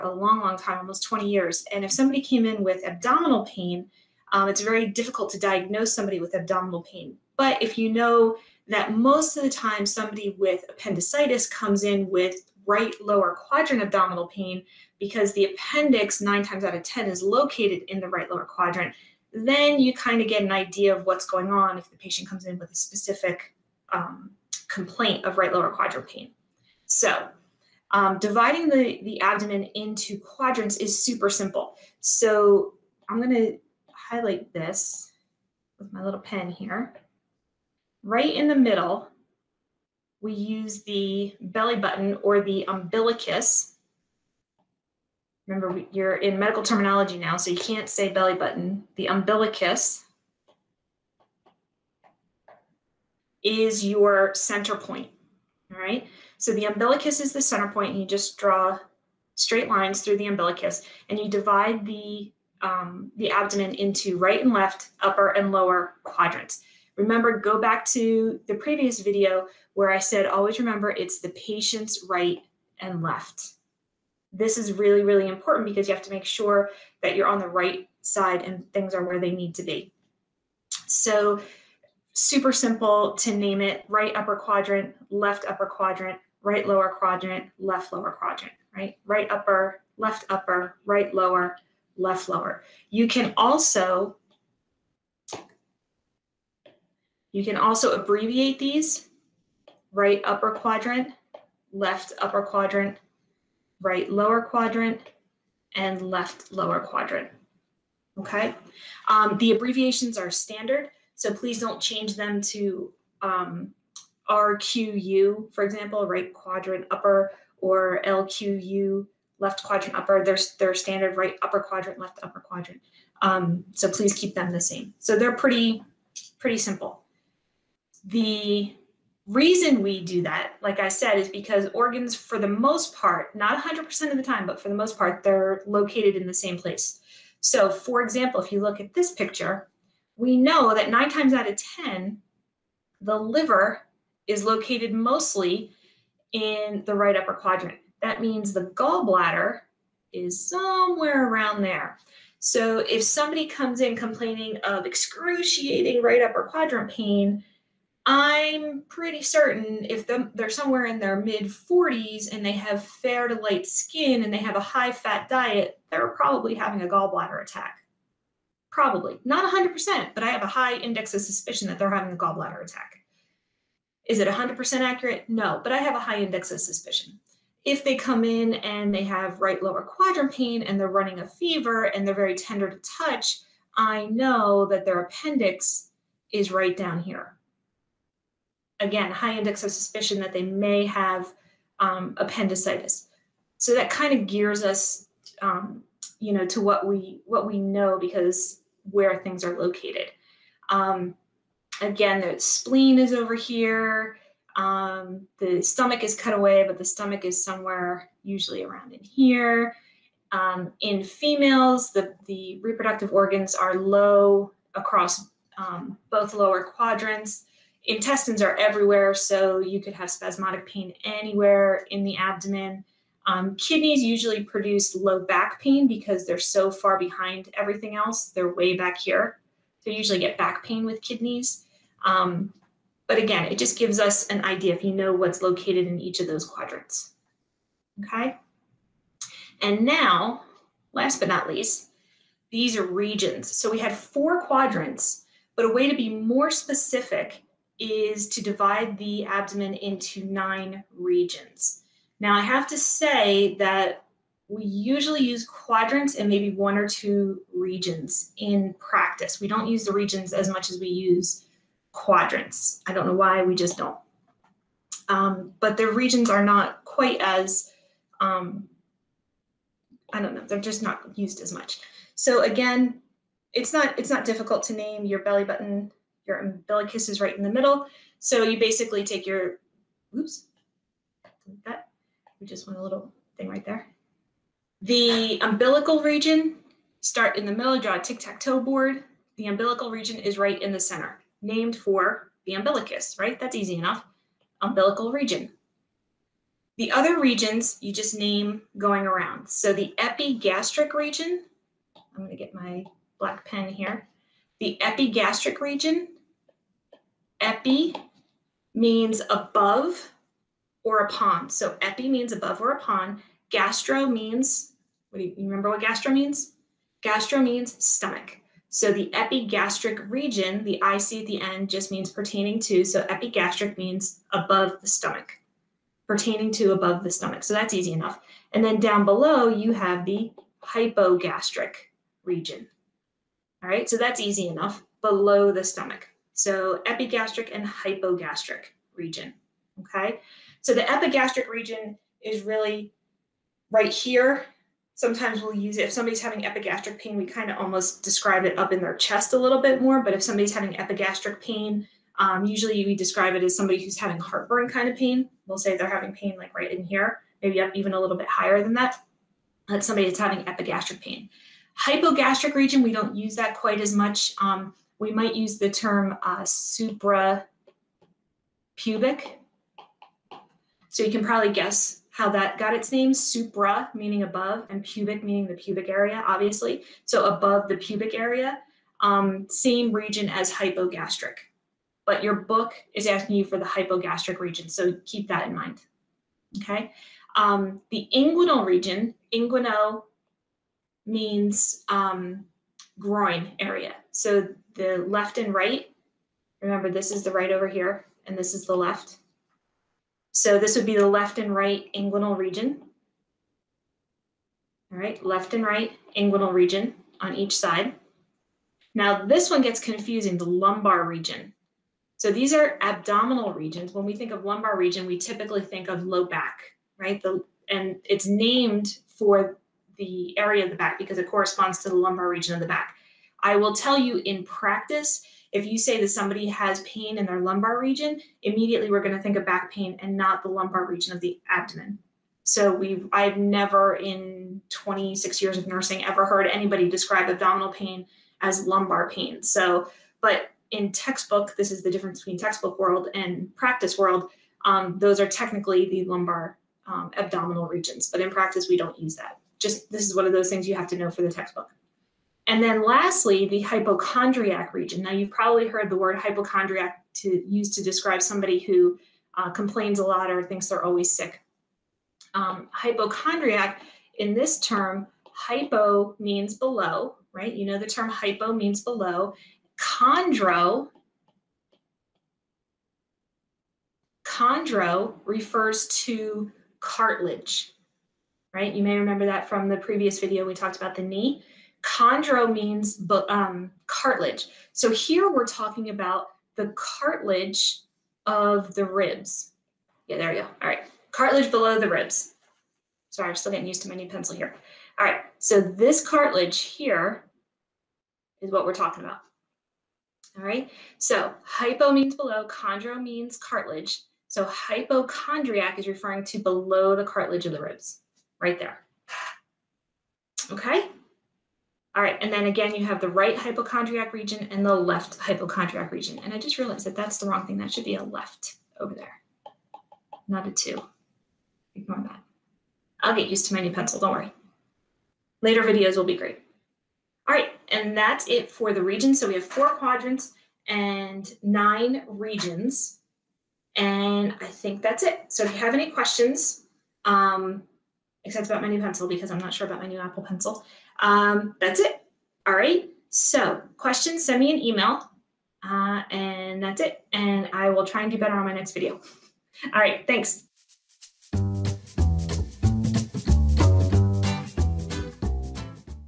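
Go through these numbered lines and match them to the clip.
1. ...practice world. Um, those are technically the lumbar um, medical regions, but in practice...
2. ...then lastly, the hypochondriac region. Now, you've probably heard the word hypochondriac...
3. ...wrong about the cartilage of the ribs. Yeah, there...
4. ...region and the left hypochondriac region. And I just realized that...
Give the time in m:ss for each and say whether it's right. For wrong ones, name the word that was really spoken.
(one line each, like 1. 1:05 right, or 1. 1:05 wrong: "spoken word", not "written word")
1. 7:23 wrong: "abdominal", not "medical"
2. 7:32 right
3. 8:05 wrong: "talking", not "wrong"
4. 8:34 right.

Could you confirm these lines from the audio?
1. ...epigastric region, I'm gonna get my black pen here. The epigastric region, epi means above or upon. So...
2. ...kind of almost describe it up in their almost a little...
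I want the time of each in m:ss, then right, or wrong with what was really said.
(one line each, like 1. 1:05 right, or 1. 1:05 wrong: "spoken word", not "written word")
1. 4:59 right
2. 5:47 wrong: "chest", not "almost".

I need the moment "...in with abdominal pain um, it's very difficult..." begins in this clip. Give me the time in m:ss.
0:02.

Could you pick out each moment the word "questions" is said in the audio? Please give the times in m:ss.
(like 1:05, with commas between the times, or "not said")
8:55, 9:03.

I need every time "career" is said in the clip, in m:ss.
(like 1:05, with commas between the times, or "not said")
not said.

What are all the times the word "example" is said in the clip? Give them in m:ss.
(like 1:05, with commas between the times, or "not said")
1:55, 2:17.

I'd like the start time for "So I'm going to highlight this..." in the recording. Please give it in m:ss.
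0:31.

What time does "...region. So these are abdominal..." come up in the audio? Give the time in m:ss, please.
6:51.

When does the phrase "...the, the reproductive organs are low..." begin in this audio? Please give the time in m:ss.
3:31.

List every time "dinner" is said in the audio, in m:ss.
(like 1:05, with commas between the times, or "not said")
not said.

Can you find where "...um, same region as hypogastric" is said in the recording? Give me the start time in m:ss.
6:18.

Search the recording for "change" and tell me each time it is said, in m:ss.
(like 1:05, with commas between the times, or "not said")
1:51.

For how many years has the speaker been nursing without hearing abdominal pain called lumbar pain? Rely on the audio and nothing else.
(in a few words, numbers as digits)
26.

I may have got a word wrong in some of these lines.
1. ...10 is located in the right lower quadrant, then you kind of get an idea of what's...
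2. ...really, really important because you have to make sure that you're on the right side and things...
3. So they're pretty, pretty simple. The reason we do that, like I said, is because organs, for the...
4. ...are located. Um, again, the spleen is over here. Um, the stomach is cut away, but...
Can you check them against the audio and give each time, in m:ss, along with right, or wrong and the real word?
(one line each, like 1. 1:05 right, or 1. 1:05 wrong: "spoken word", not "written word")
1. 0:16 right
2. 1:14 right
3. 2:04 right
4. 3:19 right.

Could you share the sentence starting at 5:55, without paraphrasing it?
We'll say they're having pain like right in here, maybe up even a little bit higher than that.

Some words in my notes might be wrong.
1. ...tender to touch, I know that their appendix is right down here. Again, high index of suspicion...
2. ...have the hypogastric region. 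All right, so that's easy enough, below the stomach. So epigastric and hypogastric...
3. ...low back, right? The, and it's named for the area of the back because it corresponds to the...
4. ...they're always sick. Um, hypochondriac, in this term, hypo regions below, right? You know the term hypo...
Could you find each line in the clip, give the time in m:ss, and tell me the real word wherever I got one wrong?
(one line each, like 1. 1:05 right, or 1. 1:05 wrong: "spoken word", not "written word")
1. 3:02 right
2. 5:29 right
3. 6:56 right
4. 7:40 wrong: "means", not "regions".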